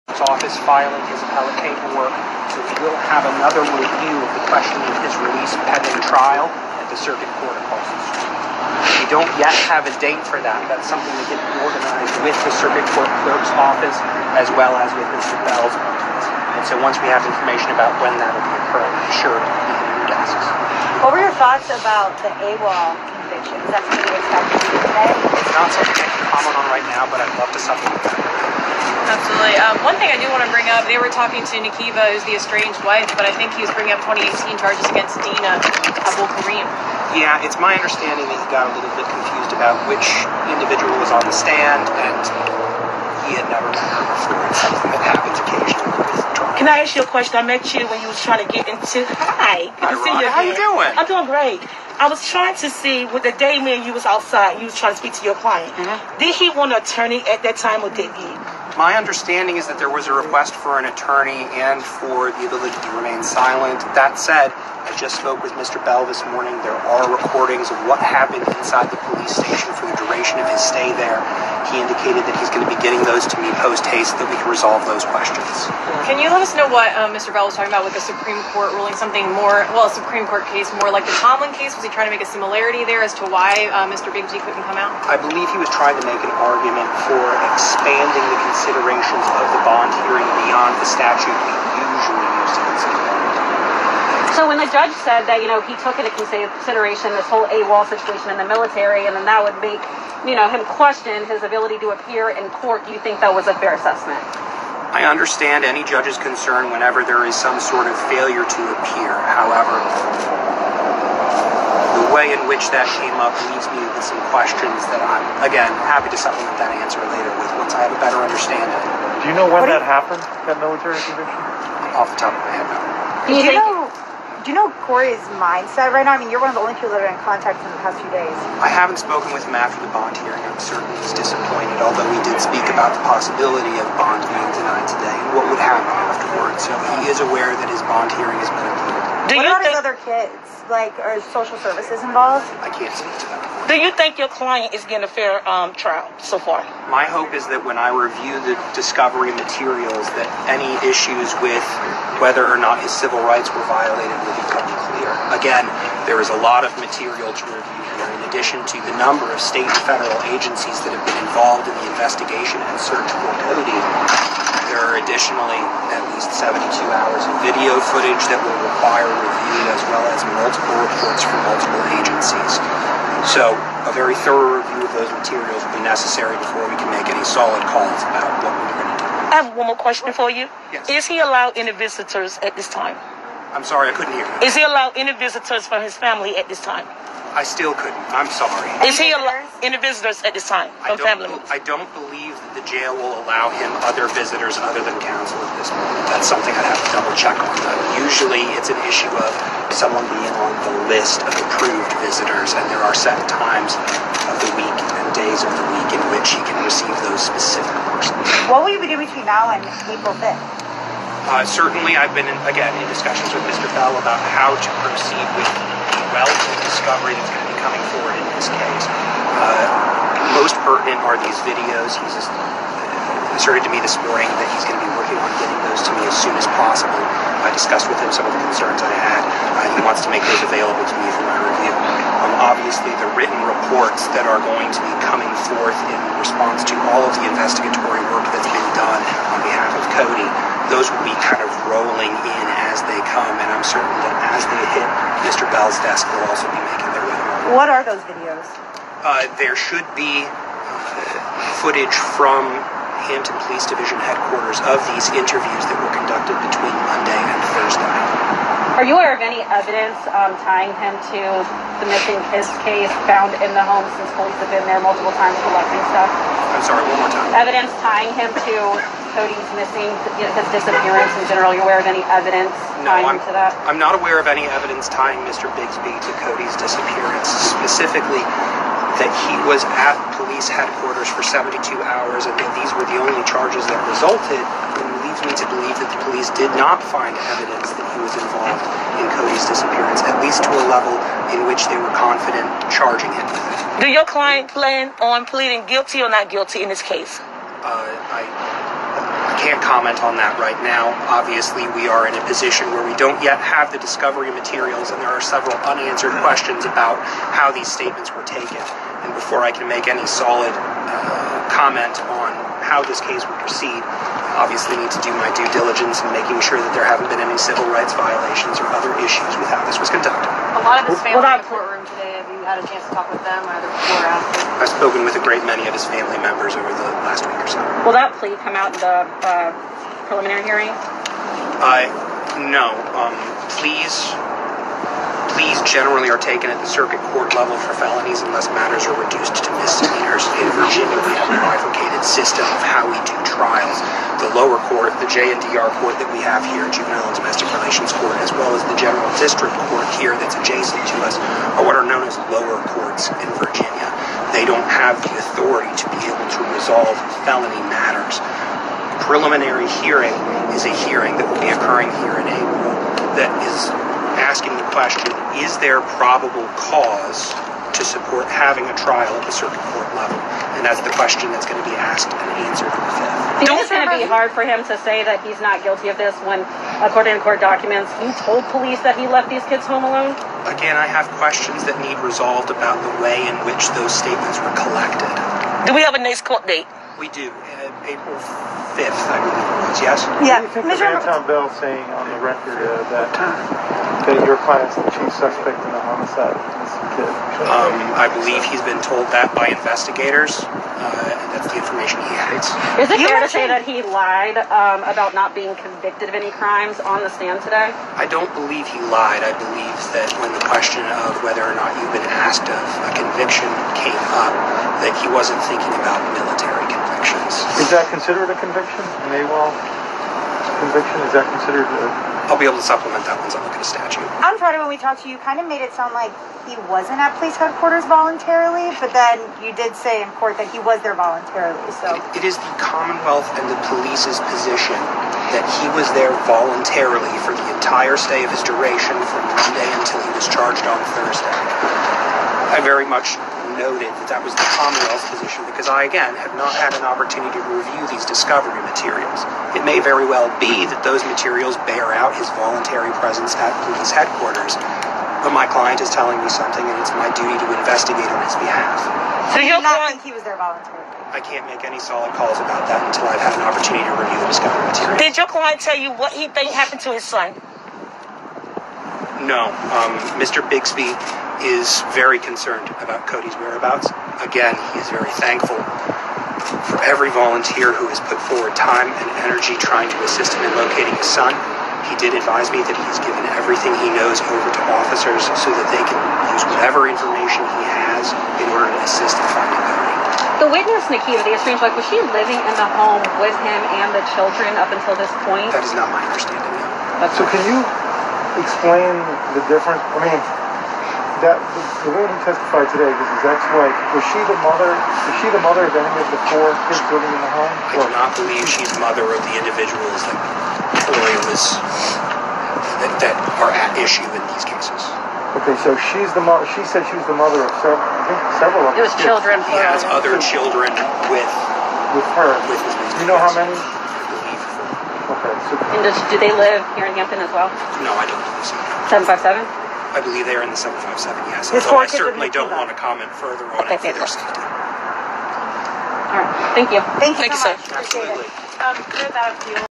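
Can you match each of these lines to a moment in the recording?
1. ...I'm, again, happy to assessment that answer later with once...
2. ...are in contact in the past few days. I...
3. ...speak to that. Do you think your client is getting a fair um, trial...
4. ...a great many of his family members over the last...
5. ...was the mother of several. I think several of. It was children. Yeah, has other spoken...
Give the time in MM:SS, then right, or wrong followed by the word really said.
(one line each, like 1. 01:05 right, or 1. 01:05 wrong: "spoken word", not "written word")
1. 01:55 wrong: "supplement", not "assessment"
2. 02:07 right
3. 02:22 right
4. 05:25 right
5. 08:36 wrong: "children", not "spoken".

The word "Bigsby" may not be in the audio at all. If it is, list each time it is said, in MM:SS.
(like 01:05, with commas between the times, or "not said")
01:24, 04:35, 07:50.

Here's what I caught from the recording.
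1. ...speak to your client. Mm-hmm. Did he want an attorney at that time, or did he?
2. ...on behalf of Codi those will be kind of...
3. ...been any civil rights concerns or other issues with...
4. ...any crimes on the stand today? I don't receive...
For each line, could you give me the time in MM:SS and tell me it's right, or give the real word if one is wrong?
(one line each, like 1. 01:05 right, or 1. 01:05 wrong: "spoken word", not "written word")
1. 00:55 right
2. 03:59 right
3. 05:17 wrong: "violations", not "concerns"
4. 06:46 wrong: "believe", not "receive".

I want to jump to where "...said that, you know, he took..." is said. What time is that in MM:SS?
01:35.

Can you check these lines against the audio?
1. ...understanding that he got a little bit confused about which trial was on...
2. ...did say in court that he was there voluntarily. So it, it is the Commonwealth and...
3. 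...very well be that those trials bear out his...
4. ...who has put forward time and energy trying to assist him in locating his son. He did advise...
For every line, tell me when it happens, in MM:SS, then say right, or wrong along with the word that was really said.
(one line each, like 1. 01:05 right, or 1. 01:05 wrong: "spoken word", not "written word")
1. 00:37 wrong: "individual", not "trial"
2. 07:09 right
3. 07:29 wrong: "materials", not "trials"
4. 07:57 right.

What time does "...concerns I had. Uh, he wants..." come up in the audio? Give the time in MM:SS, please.
03:48.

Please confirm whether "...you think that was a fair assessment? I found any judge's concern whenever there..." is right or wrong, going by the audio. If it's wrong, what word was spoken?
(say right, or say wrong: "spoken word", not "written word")
wrong: "understand", not "found".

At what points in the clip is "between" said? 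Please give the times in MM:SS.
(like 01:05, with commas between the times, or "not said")
03:29, 04:16.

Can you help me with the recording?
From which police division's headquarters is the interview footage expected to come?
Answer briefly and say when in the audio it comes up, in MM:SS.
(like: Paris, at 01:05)
Hampton Police Division, at 04:13.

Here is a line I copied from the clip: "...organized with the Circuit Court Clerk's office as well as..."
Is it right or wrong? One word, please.
right.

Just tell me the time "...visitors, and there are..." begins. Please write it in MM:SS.
03:22.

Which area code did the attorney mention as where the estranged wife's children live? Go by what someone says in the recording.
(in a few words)
757.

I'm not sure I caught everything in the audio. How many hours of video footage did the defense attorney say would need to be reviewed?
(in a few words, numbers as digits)
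72.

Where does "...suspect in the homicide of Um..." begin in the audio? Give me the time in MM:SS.
06:35.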